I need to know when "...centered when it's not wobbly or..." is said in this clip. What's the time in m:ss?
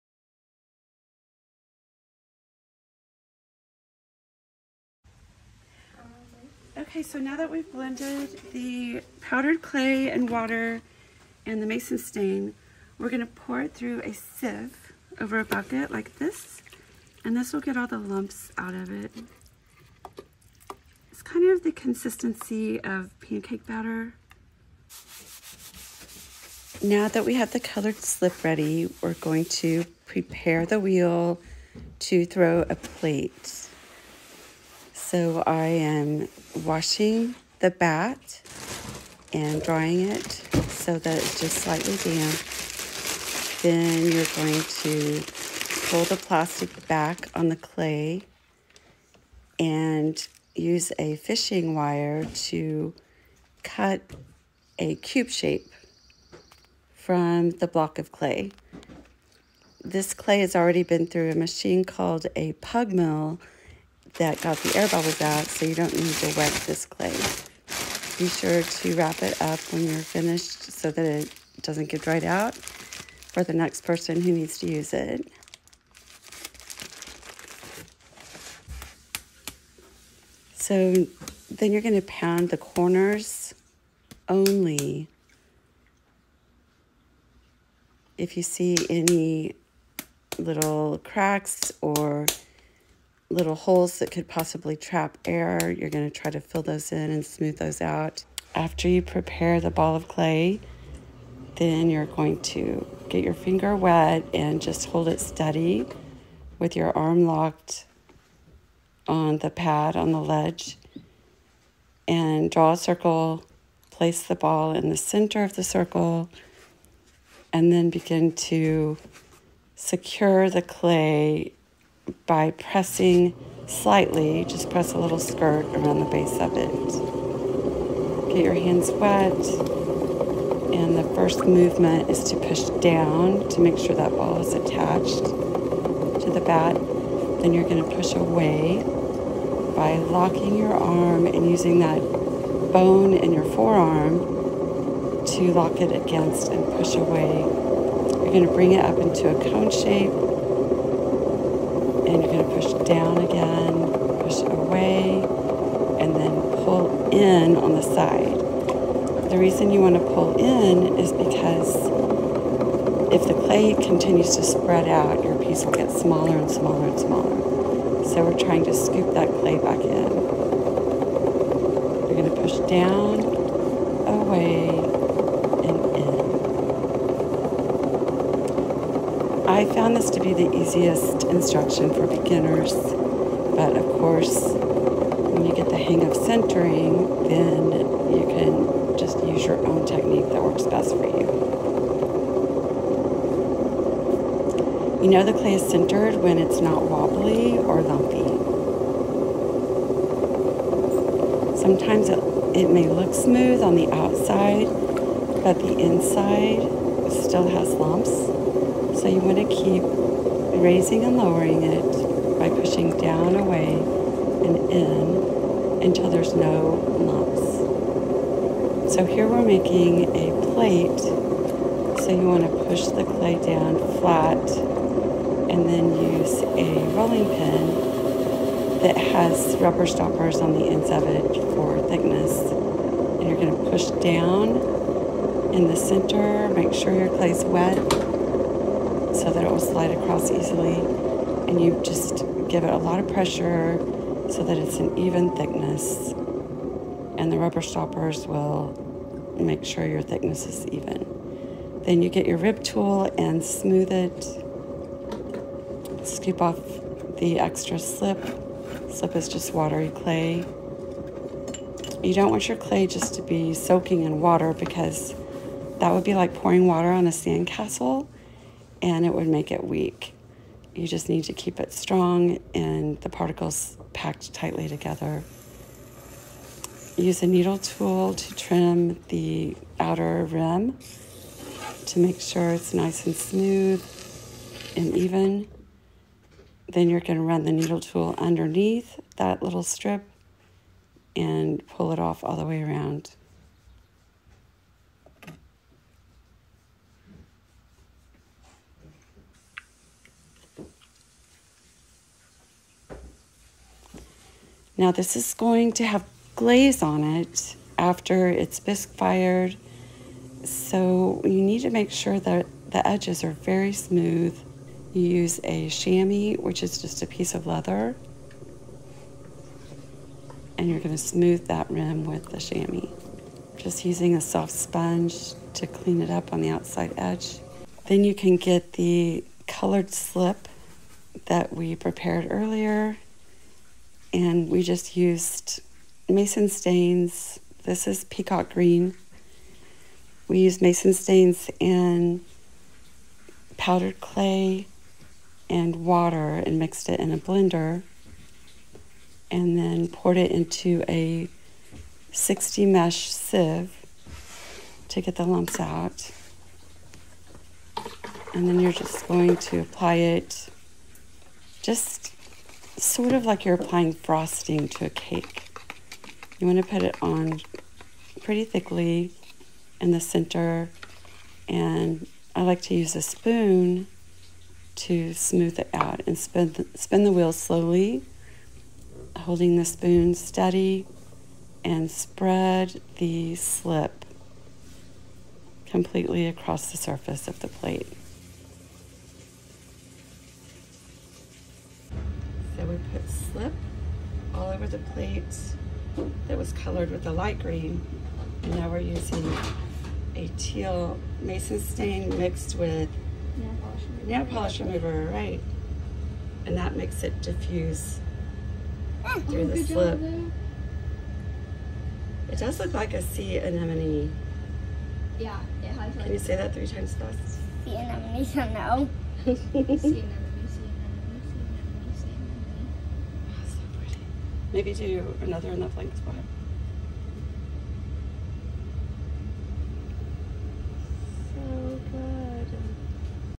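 3:15.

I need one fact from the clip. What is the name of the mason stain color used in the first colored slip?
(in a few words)
peacock green.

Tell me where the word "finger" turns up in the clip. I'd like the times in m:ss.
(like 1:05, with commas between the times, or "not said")
1:43.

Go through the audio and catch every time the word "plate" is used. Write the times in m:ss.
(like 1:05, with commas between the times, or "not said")
0:32, 3:40, 6:27, 6:34.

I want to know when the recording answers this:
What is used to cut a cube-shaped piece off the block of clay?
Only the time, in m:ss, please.
0:51.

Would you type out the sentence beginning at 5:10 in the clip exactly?
So you need to make sure that the edges are very smooth.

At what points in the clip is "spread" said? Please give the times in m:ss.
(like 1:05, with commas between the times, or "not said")
2:44, 6:21.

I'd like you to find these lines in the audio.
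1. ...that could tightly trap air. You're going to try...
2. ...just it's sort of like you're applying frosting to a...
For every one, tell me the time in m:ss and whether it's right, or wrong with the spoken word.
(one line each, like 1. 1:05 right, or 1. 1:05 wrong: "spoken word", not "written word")
1. 1:33 wrong: "possibly", not "tightly"
2. 6:01 right.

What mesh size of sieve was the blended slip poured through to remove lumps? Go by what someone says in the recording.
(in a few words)
60.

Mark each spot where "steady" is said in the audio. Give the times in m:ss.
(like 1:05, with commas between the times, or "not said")
1:45, 6:20.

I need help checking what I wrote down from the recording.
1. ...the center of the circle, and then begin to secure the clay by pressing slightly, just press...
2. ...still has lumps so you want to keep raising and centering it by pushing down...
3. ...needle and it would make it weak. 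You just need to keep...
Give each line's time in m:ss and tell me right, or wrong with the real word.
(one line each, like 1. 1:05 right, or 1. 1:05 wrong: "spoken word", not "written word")
1. 1:54 right
2. 3:27 wrong: "lowering", not "centering"
3. 4:27 wrong: "sandcastle", not "needle".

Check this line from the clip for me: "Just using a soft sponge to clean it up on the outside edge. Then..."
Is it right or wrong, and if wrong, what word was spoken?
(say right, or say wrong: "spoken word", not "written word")
right.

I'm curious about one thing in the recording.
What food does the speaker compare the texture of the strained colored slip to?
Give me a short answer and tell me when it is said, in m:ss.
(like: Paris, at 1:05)
pancake batter, at 0:23.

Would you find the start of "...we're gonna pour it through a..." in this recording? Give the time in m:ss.
0:12.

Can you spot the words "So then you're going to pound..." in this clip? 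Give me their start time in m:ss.
1:20.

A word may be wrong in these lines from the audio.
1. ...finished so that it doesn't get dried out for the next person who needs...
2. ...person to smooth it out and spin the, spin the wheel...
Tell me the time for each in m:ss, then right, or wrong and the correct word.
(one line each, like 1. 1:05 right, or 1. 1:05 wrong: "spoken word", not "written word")
1. 1:09 right
2. 6:13 wrong: "spoon", not "person".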